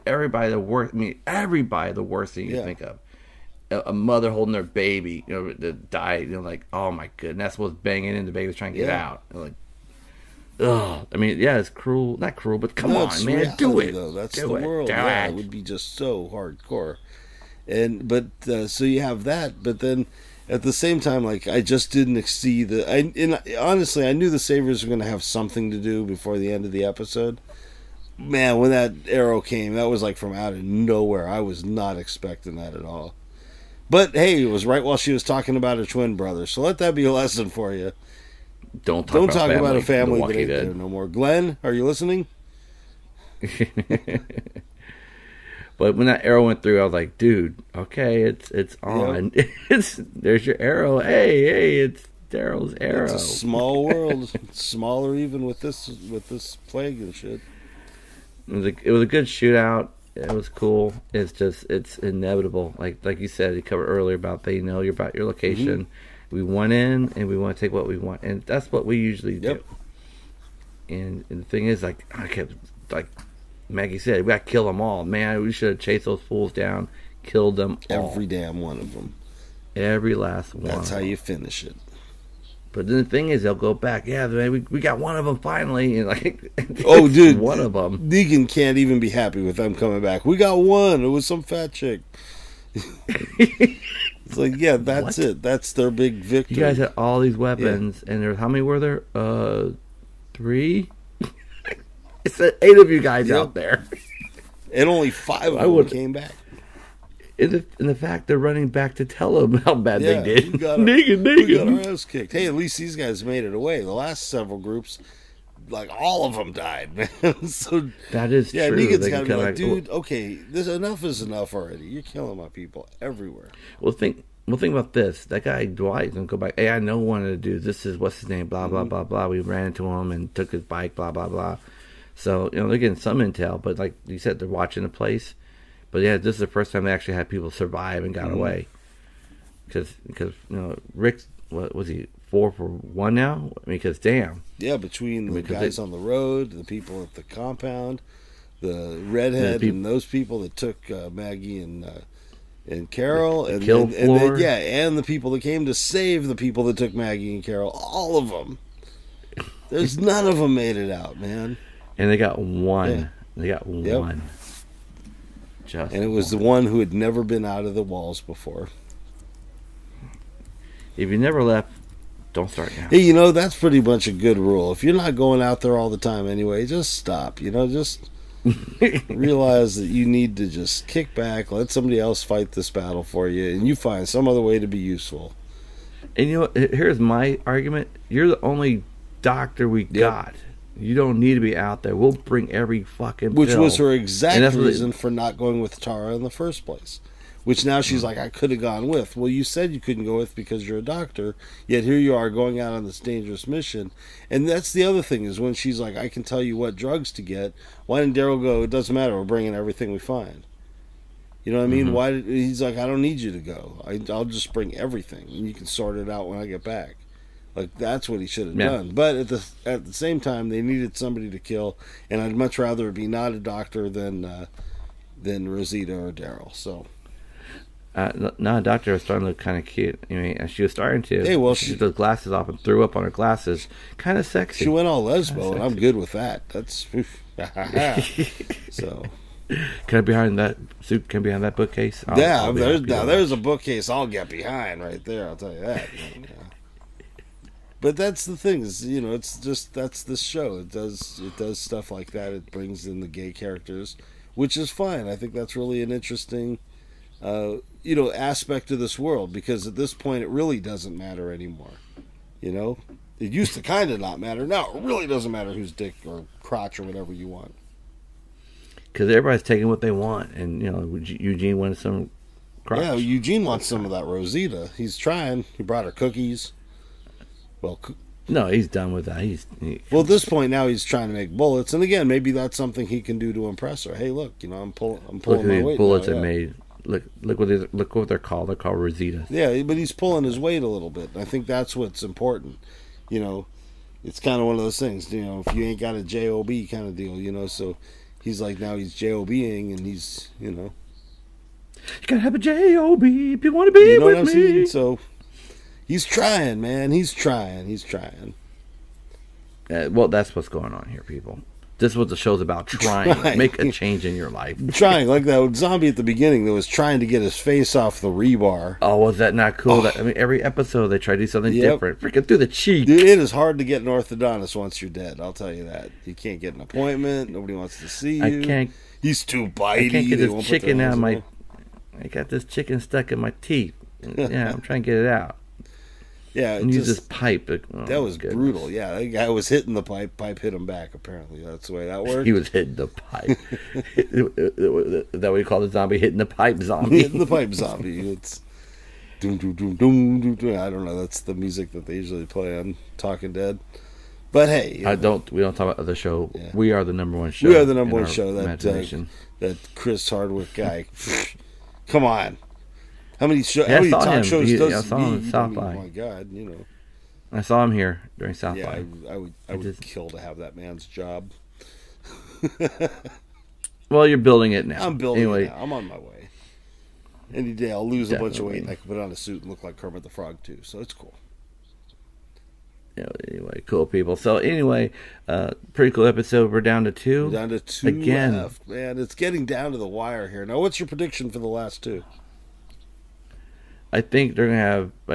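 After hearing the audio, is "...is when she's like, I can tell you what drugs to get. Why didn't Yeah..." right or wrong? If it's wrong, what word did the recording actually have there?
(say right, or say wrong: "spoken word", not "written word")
wrong: "Daryl", not "Yeah".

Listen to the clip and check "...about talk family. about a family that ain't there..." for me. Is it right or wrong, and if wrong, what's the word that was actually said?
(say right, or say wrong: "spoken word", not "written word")
right.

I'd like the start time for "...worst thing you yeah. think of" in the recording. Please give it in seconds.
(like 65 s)
2 s.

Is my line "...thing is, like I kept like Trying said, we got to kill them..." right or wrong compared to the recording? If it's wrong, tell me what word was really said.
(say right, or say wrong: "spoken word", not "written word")
wrong: "Maggie", not "Trying".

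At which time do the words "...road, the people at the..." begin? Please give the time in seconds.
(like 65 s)
145 s.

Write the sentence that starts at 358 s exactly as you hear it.
That uh, that Chris Hardwick guy.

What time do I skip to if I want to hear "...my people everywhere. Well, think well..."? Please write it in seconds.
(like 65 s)
122 s.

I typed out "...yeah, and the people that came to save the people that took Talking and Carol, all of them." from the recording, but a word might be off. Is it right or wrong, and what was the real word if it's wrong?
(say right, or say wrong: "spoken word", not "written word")
wrong: "Maggie", not "Talking".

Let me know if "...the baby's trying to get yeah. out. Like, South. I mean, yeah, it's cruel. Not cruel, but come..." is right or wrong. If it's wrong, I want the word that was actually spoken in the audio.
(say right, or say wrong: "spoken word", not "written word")
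wrong: "Ugh", not "South".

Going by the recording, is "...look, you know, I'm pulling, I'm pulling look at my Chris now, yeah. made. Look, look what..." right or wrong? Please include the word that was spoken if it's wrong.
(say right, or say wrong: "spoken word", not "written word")
wrong: "Bullets", not "Chris".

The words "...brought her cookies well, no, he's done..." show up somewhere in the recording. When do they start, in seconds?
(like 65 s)
275 s.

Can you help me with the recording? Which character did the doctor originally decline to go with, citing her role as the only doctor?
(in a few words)
Tara.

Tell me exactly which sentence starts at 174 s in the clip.
If you're not going out there all the time anyway, just stop.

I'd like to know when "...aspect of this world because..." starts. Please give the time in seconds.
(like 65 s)
258 s.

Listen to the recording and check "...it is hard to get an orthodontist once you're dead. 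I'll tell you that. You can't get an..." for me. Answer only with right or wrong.
right.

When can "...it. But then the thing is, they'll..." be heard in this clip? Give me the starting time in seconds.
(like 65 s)
81 s.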